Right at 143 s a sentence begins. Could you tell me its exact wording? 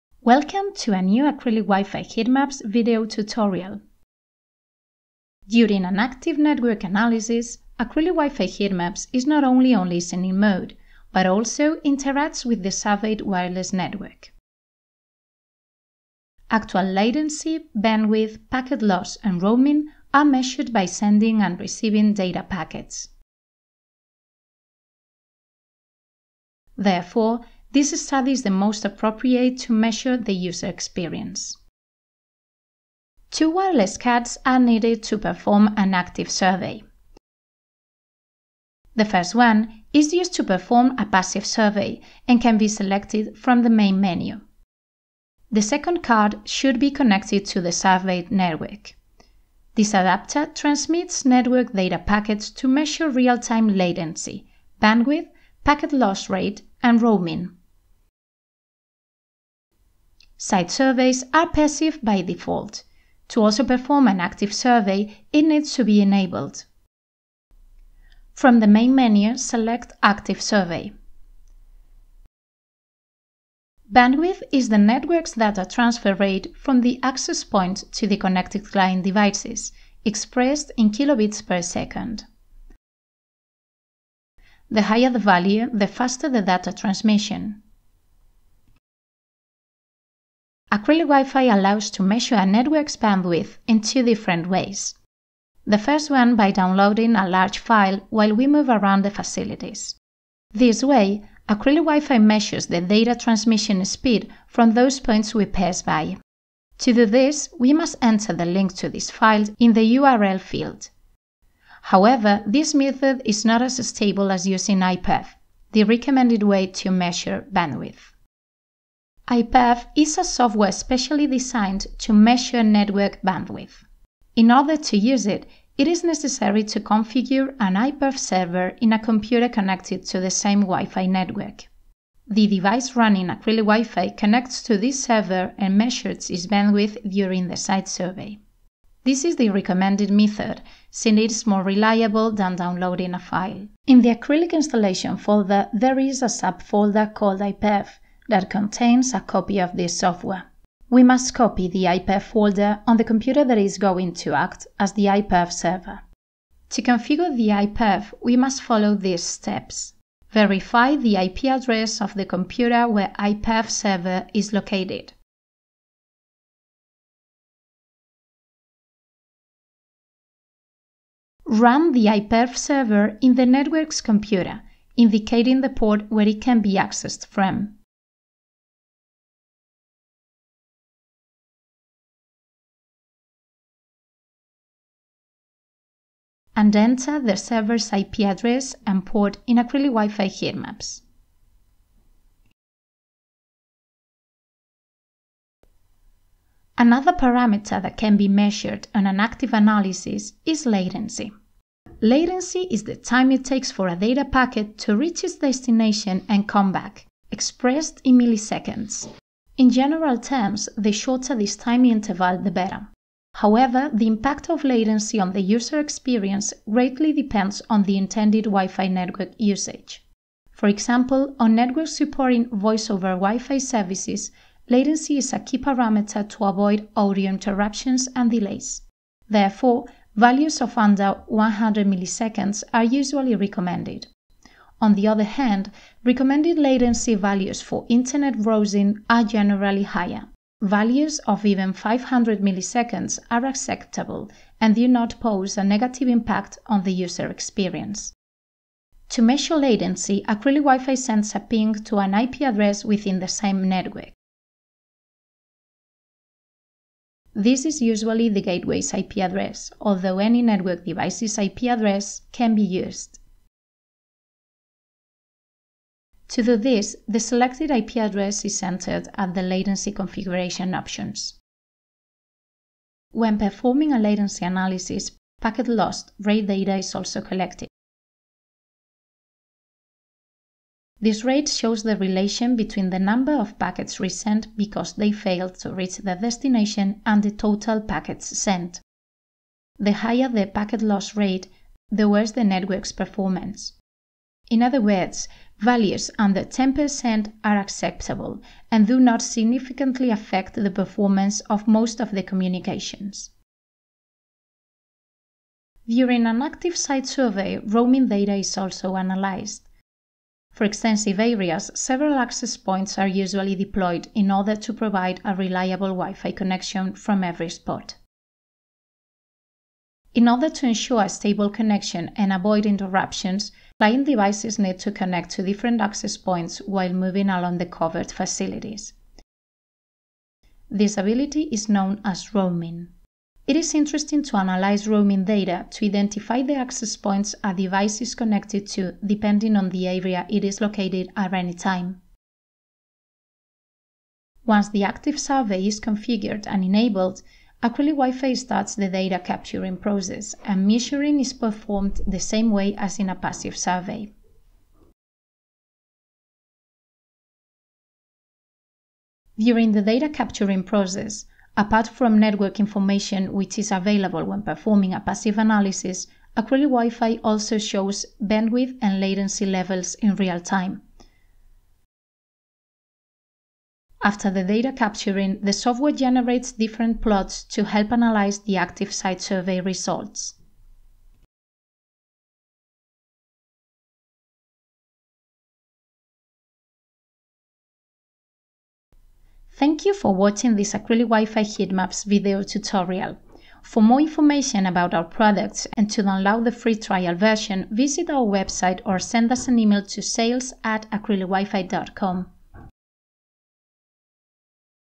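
In the Acrylic installation folder, there is a subfolder called IPEV, that contains a copy of this software.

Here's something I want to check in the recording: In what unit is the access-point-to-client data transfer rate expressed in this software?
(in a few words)
kilobits per second.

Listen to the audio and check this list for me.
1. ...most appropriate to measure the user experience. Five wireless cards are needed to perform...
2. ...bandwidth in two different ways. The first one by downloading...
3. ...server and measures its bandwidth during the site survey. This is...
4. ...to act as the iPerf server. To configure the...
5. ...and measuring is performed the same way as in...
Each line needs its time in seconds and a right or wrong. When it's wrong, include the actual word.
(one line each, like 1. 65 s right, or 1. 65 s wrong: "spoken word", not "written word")
1. 28 s wrong: "Two", not "Five"
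2. 92 s right
3. 135 s right
4. 154 s right
5. 350 s right.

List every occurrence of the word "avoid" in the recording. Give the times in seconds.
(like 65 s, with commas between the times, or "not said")
226 s, 322 s.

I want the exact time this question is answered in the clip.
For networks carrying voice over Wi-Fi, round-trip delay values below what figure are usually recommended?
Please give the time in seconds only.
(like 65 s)
231 s.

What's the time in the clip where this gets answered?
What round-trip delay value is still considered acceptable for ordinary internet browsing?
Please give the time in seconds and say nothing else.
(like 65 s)
241 s.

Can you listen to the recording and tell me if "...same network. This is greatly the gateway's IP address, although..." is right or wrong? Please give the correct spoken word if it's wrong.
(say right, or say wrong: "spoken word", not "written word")
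wrong: "usually", not "greatly".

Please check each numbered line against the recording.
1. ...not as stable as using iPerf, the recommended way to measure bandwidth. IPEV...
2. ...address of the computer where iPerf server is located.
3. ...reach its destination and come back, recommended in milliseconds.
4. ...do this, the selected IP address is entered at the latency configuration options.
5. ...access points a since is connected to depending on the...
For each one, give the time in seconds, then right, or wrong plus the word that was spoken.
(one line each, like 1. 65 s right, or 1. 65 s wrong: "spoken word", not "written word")
1. 113 s right
2. 161 s right
3. 204 s wrong: "expressed", not "recommended"
4. 266 s right
5. 336 s wrong: "device", not "since".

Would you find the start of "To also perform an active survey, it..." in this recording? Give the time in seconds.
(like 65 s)
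63 s.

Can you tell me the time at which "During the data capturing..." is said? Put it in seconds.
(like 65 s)
359 s.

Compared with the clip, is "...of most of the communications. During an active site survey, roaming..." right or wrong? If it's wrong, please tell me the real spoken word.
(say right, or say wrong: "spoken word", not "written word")
right.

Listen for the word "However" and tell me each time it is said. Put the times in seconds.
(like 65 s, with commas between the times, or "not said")
111 s, 213 s.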